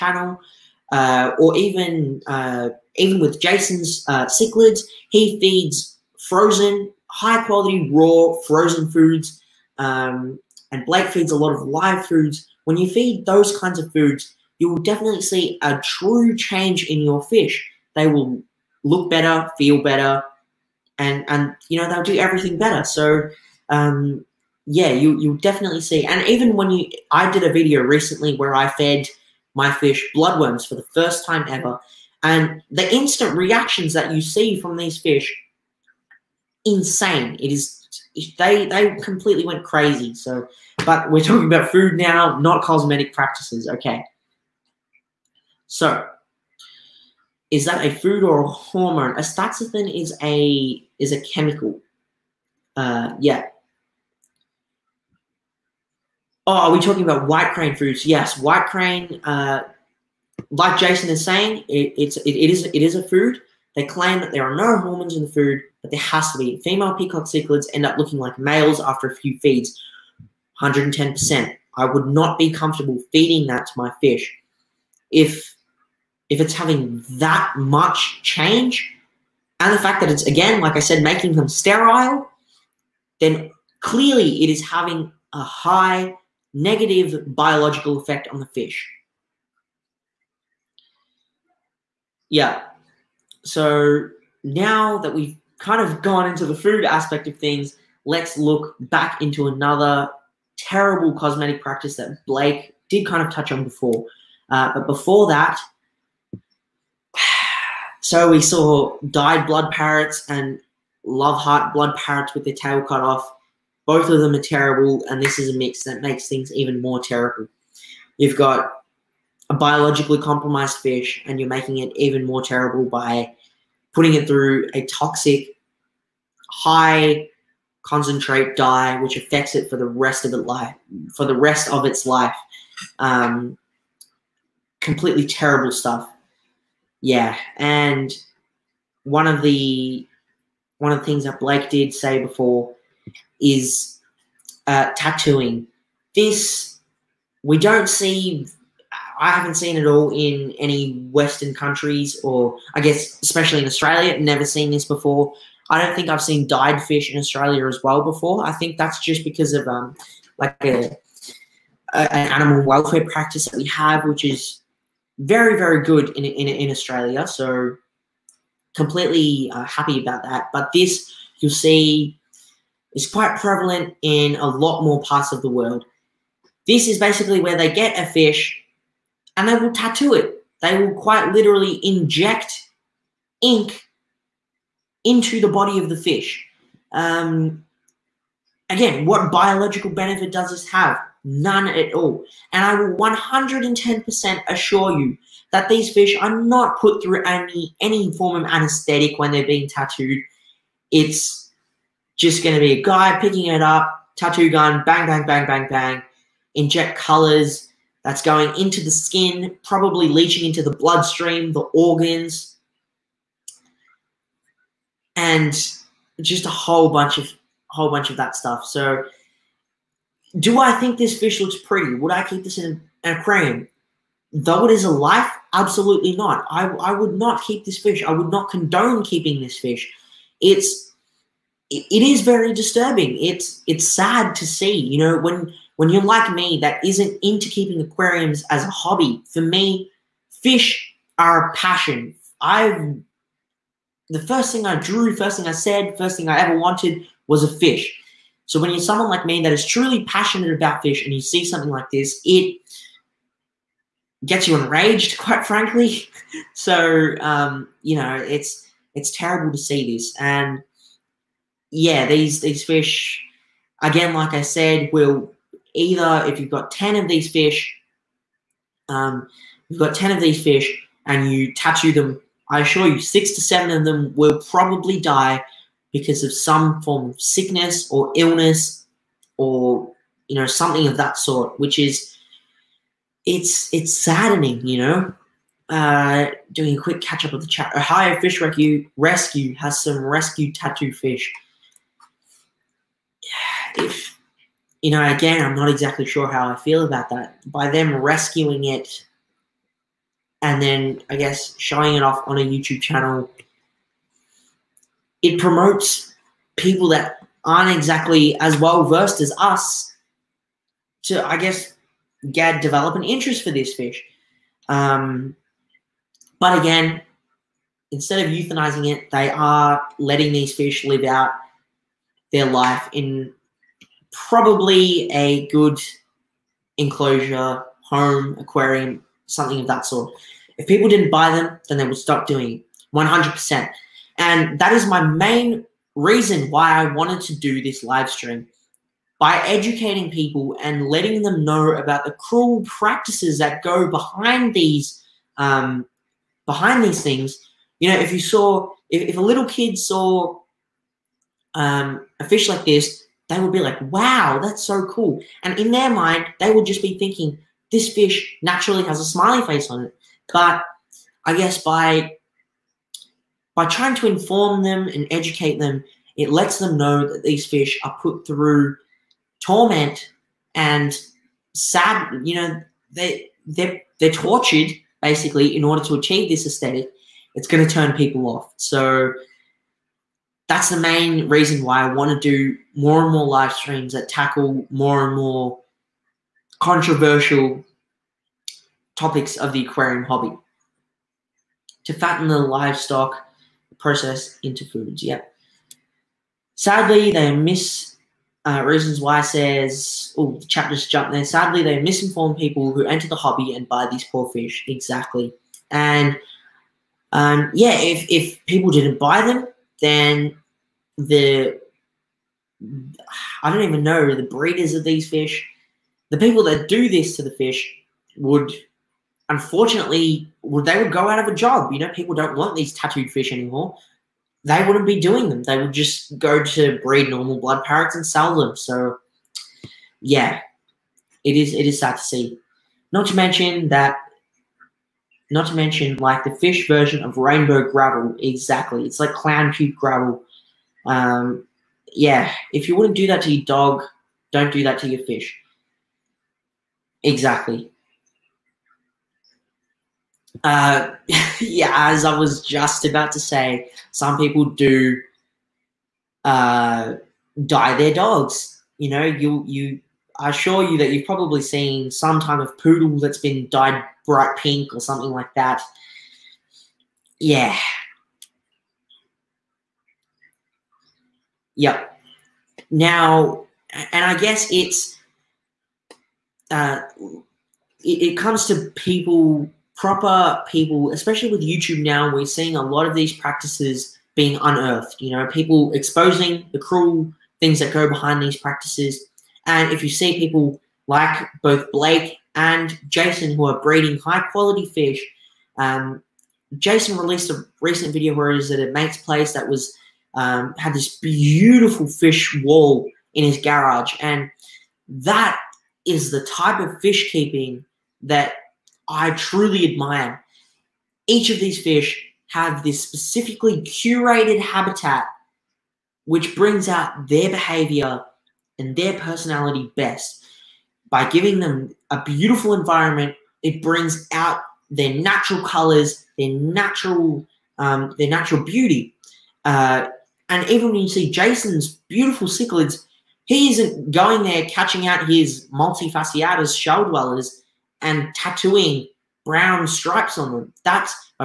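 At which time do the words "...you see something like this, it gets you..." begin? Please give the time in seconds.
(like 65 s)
251 s.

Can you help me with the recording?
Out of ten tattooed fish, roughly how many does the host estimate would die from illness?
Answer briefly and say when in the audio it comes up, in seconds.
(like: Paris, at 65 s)
6 to 7, at 272 s.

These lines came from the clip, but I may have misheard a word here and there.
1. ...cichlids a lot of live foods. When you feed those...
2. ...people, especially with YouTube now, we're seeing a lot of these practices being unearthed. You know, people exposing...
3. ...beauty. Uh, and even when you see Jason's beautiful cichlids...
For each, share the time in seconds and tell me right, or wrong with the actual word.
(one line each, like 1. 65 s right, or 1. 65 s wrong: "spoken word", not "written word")
1. 11 s wrong: "feeds", not "cichlids"
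2. 480 s right
3. 528 s right.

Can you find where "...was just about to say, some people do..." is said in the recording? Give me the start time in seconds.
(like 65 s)
452 s.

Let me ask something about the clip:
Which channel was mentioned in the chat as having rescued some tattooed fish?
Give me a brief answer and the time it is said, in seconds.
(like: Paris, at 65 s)
Ohio Fish Rescue, at 287 s.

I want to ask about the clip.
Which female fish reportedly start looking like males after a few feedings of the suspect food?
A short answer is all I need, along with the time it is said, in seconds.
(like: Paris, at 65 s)
Peacock cichlids, at 66 s.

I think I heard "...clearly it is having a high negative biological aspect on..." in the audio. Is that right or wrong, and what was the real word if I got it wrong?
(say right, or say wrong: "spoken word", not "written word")
wrong: "effect", not "aspect".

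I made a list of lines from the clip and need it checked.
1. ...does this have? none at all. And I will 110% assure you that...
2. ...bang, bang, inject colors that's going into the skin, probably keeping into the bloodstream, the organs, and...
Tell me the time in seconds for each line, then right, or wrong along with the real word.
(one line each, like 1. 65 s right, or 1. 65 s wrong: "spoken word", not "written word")
1. 190 s right
2. 205 s wrong: "leaching", not "keeping".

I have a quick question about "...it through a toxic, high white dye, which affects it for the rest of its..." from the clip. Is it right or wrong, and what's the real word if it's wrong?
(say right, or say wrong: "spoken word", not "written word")
wrong: "concentrate", not "white".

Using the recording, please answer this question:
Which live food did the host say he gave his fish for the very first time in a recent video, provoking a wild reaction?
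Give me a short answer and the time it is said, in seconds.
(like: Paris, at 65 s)
Bloodworms, at 30 s.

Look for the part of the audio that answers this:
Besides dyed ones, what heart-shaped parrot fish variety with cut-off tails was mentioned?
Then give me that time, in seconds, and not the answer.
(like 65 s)
111 s.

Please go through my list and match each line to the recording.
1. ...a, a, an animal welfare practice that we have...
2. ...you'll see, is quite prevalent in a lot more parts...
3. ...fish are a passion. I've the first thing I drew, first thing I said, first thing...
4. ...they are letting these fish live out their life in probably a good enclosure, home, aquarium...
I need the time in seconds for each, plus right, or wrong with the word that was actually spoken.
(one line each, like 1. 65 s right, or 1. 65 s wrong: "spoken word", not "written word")
1. 160 s right
2. 171 s right
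3. 240 s right
4. 319 s right.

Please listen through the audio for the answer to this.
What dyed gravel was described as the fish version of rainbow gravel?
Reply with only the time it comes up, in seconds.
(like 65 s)
439 s.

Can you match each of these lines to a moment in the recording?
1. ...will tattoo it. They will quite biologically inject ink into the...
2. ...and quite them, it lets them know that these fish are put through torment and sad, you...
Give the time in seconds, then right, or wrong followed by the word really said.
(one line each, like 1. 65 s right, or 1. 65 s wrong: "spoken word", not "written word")
1. 179 s wrong: "literally", not "biologically"
2. 364 s wrong: "educate", not "quite".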